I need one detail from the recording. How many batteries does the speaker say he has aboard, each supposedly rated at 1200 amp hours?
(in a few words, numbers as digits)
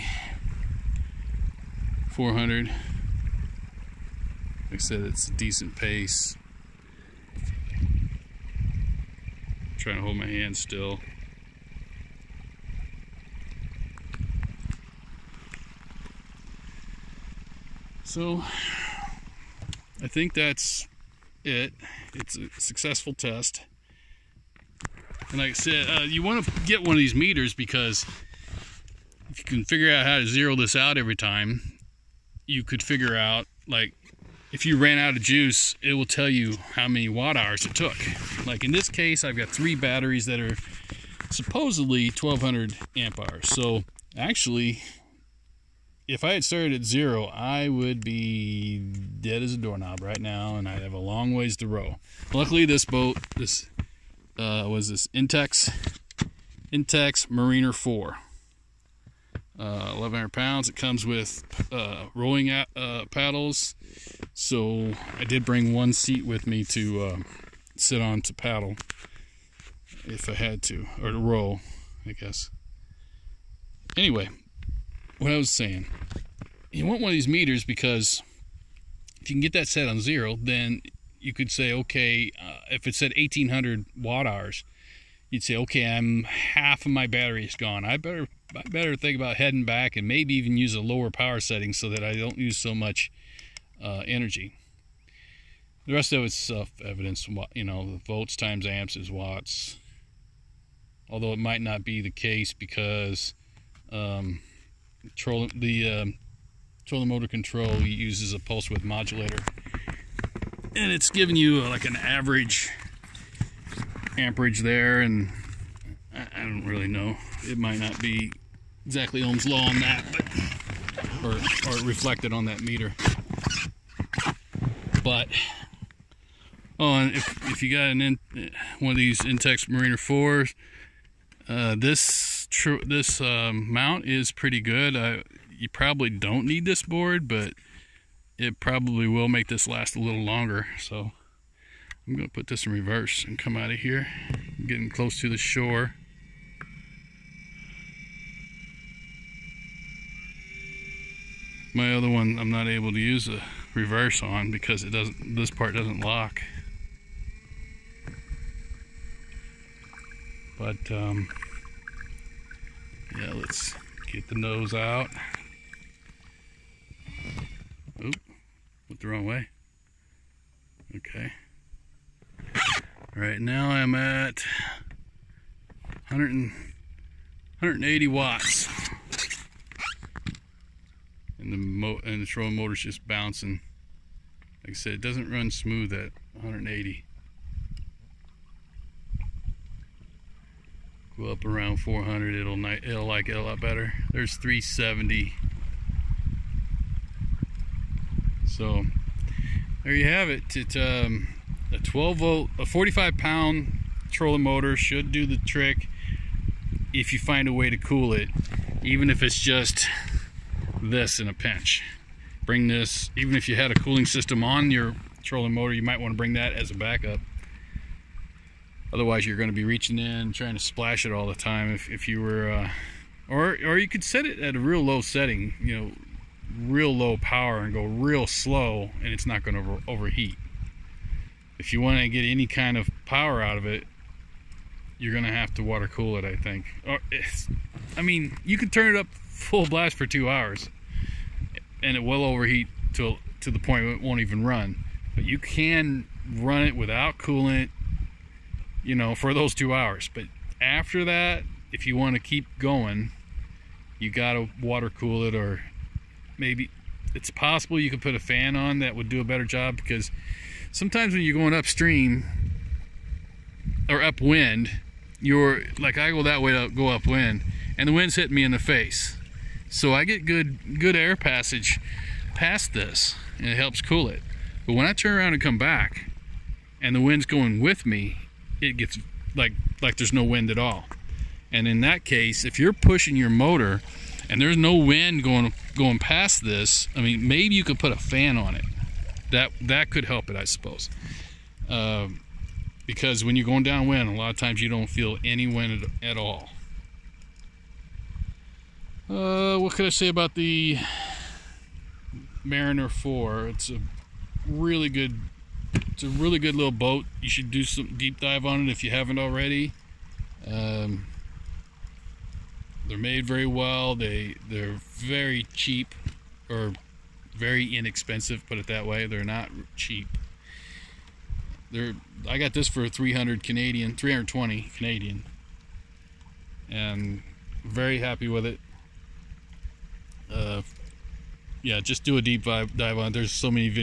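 3.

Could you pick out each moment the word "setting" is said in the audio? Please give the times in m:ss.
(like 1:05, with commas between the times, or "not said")
1:31, 3:45.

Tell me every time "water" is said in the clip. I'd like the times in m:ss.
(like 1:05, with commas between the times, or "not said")
3:55, 4:14.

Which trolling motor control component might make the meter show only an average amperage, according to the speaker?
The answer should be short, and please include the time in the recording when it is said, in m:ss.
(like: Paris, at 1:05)
pulse width modulator, at 1:48.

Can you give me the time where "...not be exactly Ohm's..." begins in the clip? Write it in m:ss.
1:57.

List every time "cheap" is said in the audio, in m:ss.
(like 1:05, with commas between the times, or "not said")
5:15, 5:19.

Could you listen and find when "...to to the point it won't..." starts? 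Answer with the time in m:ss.
4:02.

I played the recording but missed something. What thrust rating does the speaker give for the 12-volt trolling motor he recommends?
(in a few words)
45 pound.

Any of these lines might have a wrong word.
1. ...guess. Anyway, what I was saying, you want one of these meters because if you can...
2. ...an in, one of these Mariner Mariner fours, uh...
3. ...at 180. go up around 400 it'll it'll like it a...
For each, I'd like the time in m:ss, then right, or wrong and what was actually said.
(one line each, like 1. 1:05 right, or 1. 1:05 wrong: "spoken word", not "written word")
1. 1:12 right
2. 2:07 wrong: "Intex", not "Mariner"
3. 3:05 right.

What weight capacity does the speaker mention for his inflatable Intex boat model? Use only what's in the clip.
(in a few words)
1,100 pounds.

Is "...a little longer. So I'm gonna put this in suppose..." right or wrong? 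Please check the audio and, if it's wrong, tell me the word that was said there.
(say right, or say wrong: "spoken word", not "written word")
wrong: "reverse", not "suppose".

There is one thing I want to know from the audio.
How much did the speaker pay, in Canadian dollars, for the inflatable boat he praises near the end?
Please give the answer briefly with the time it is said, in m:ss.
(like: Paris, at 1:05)
320, at 5:23.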